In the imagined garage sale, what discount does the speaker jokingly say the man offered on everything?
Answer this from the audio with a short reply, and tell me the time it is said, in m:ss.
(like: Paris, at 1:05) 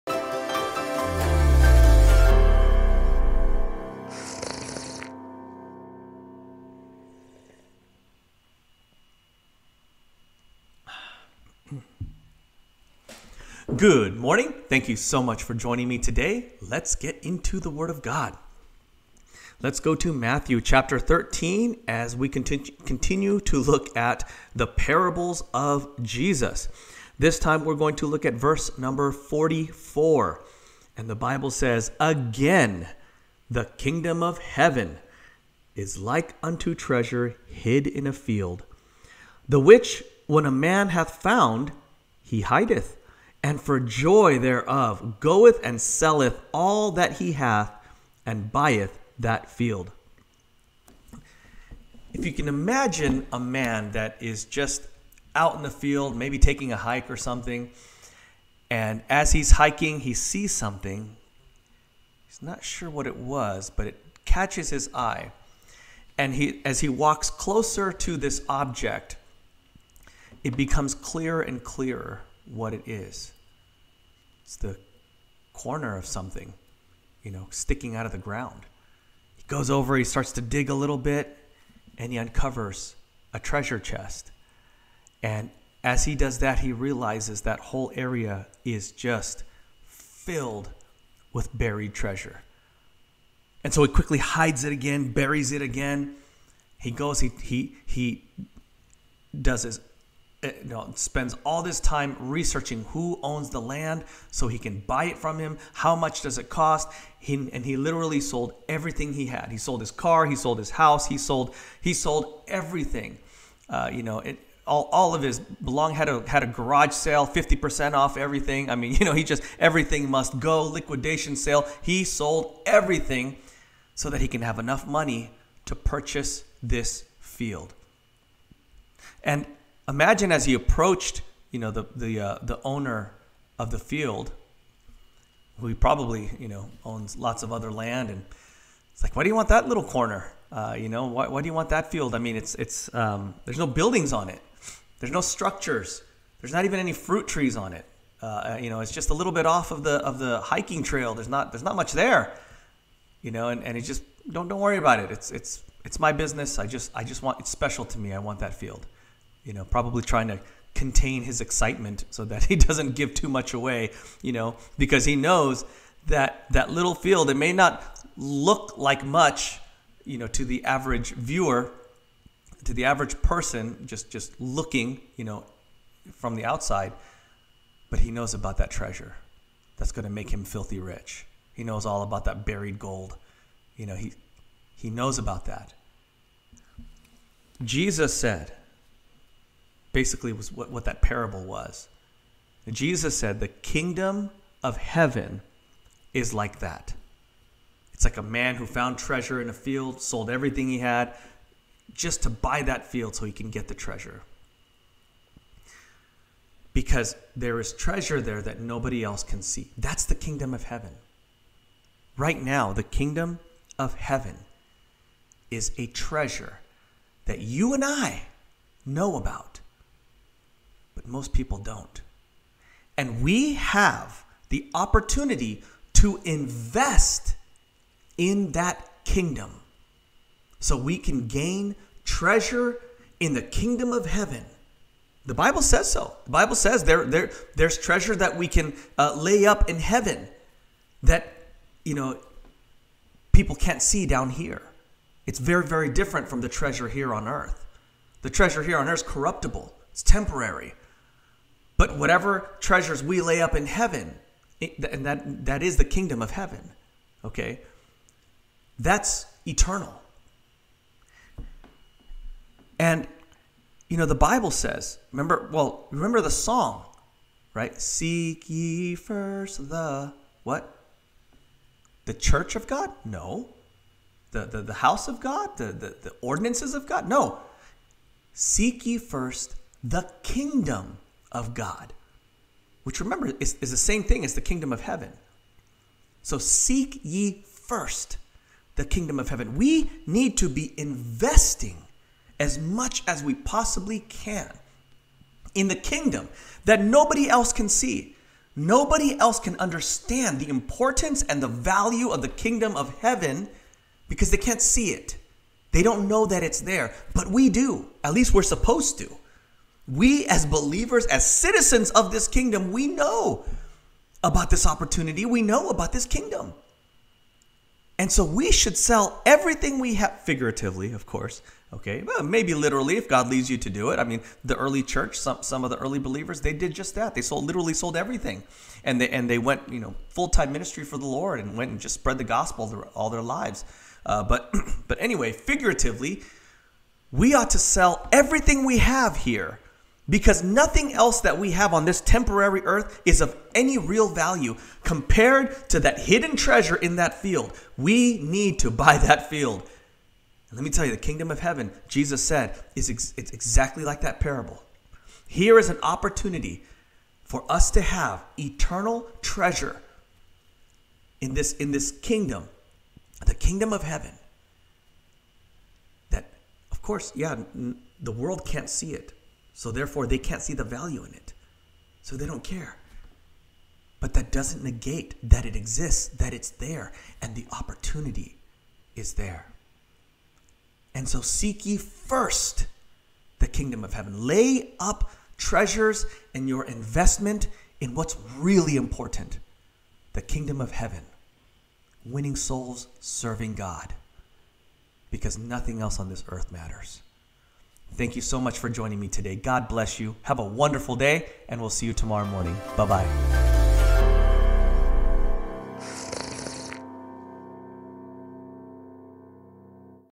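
50 percent off, at 1:57.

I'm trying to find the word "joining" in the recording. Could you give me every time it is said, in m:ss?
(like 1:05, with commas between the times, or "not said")
0:15, 6:38.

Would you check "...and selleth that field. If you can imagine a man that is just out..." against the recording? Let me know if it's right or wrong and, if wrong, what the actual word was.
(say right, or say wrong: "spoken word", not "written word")
wrong: "buyeth", not "selleth".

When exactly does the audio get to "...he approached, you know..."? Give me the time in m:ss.
2:10.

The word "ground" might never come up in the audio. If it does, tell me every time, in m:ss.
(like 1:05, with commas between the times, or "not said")
1:18.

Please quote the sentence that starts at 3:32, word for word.
Right now, the kingdom of heaven is a treasure that you and I know about most people don't.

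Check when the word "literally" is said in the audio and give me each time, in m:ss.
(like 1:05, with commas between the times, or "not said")
1:47, 5:22, 5:27.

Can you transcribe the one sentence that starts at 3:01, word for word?
He knows all about that buried gold.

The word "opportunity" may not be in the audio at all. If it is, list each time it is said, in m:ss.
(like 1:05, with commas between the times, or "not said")
3:44, 5:14, 5:55, 6:17.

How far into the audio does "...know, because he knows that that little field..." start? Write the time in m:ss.
2:44.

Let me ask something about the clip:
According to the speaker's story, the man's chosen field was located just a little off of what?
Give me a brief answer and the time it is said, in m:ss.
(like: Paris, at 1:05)
The hiking trail, at 2:30.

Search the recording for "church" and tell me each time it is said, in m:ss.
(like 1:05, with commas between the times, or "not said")
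4:32, 5:24.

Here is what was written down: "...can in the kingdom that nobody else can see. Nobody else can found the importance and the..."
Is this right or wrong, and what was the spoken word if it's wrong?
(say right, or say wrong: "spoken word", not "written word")
wrong: "understand", not "found".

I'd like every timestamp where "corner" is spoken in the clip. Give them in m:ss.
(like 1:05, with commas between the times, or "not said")
1:15, 2:19.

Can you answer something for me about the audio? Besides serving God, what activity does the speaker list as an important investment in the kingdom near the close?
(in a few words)
Winning souls.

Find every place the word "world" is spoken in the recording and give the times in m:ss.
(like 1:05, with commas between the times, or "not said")
6:08.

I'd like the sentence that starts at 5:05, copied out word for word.
They don't know that it's there, but we do.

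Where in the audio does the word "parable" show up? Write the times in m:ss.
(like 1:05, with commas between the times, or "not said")
0:24, 3:11, 5:54.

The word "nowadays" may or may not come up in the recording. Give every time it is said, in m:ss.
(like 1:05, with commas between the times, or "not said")
not said.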